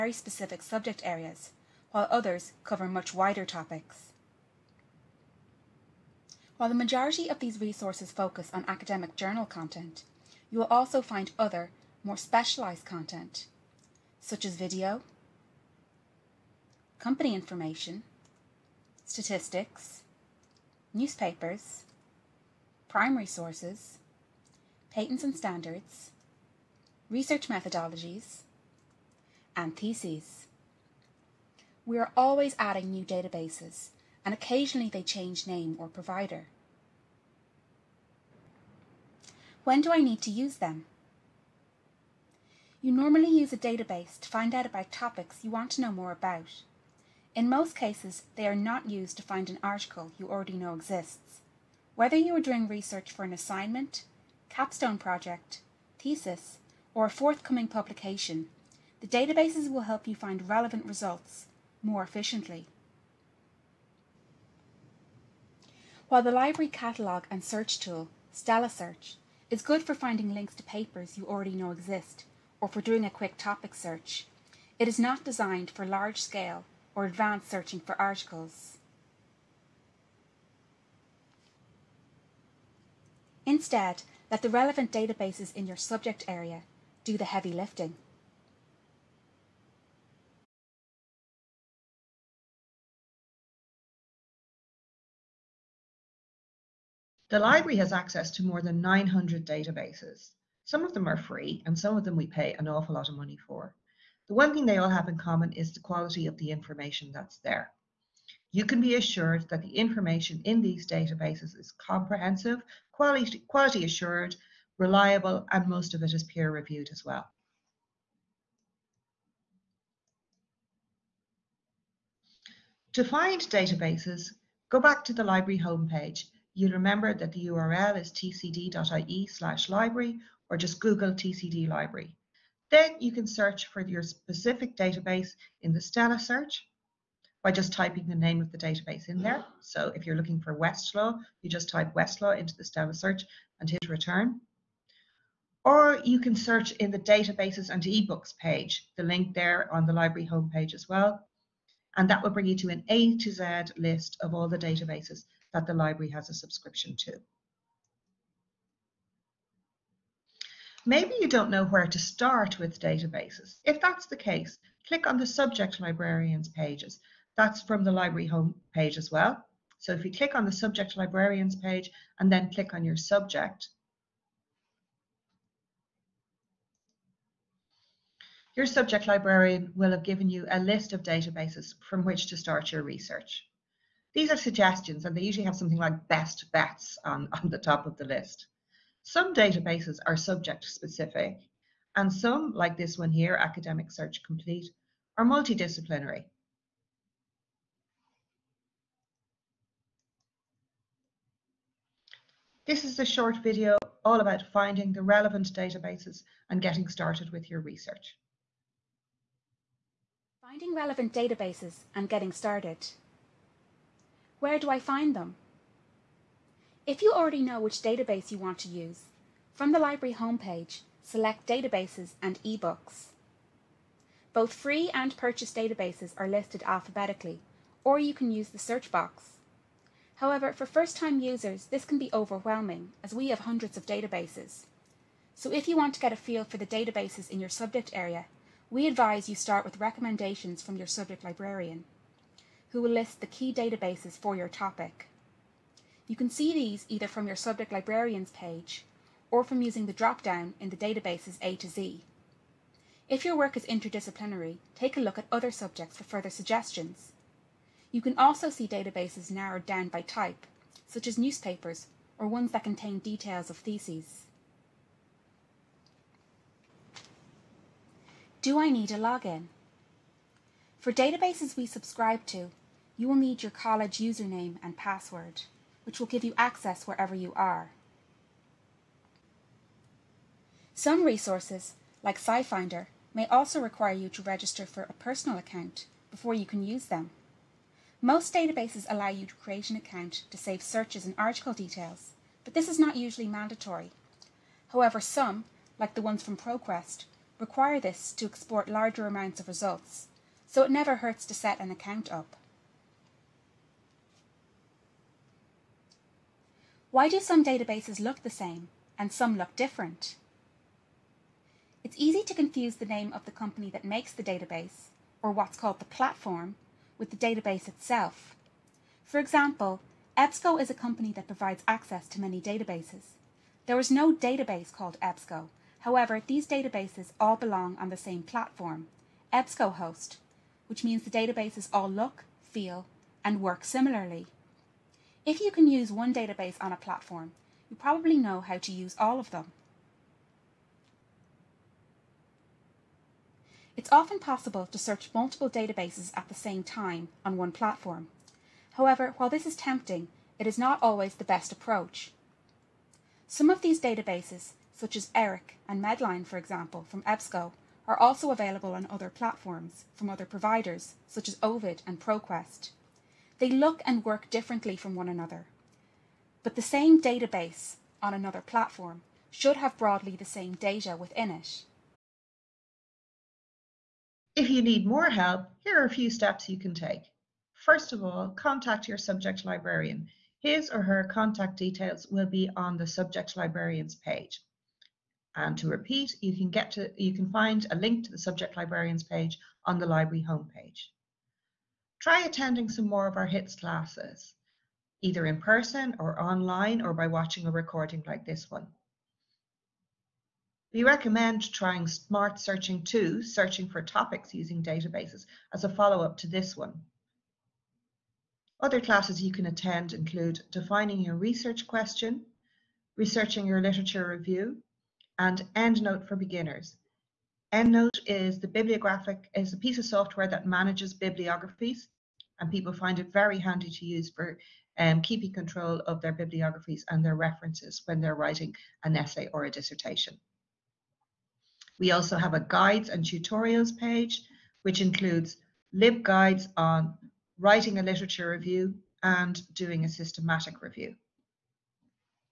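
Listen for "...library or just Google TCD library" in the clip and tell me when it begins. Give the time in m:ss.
2:09.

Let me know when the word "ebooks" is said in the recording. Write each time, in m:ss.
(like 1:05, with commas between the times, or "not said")
2:27, 3:42.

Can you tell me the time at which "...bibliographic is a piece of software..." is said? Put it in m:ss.
6:58.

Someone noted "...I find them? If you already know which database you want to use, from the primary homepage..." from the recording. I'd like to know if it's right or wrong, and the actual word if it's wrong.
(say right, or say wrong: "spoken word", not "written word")
wrong: "library", not "primary".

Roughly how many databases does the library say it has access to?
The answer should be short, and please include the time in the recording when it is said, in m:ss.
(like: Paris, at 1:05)
900, at 1:38.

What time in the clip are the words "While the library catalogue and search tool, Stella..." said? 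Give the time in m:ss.
1:06.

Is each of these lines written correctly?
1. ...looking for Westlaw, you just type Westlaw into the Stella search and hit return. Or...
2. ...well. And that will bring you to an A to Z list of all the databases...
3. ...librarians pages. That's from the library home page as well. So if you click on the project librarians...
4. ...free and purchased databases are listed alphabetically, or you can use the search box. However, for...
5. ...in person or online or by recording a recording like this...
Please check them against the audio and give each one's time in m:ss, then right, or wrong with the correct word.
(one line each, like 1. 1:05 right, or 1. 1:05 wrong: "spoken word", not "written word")
1. 2:20 right
2. 2:30 right
3. 2:45 wrong: "subject", not "project"
4. 3:44 right
5. 6:35 wrong: "watching", not "recording".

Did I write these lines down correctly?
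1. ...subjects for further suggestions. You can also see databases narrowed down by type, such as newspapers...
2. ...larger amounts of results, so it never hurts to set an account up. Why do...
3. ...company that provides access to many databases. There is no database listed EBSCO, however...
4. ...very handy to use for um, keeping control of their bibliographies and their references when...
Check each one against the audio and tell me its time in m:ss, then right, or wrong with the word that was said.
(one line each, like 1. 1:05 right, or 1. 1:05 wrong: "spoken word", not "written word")
1. 4:15 right
2. 4:58 right
3. 5:20 wrong: "called", not "listed"
4. 7:03 right.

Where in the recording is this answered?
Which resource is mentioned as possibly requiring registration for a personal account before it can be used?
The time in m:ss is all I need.
4:42.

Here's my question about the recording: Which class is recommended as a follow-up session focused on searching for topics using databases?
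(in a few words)
Smart Searching 2.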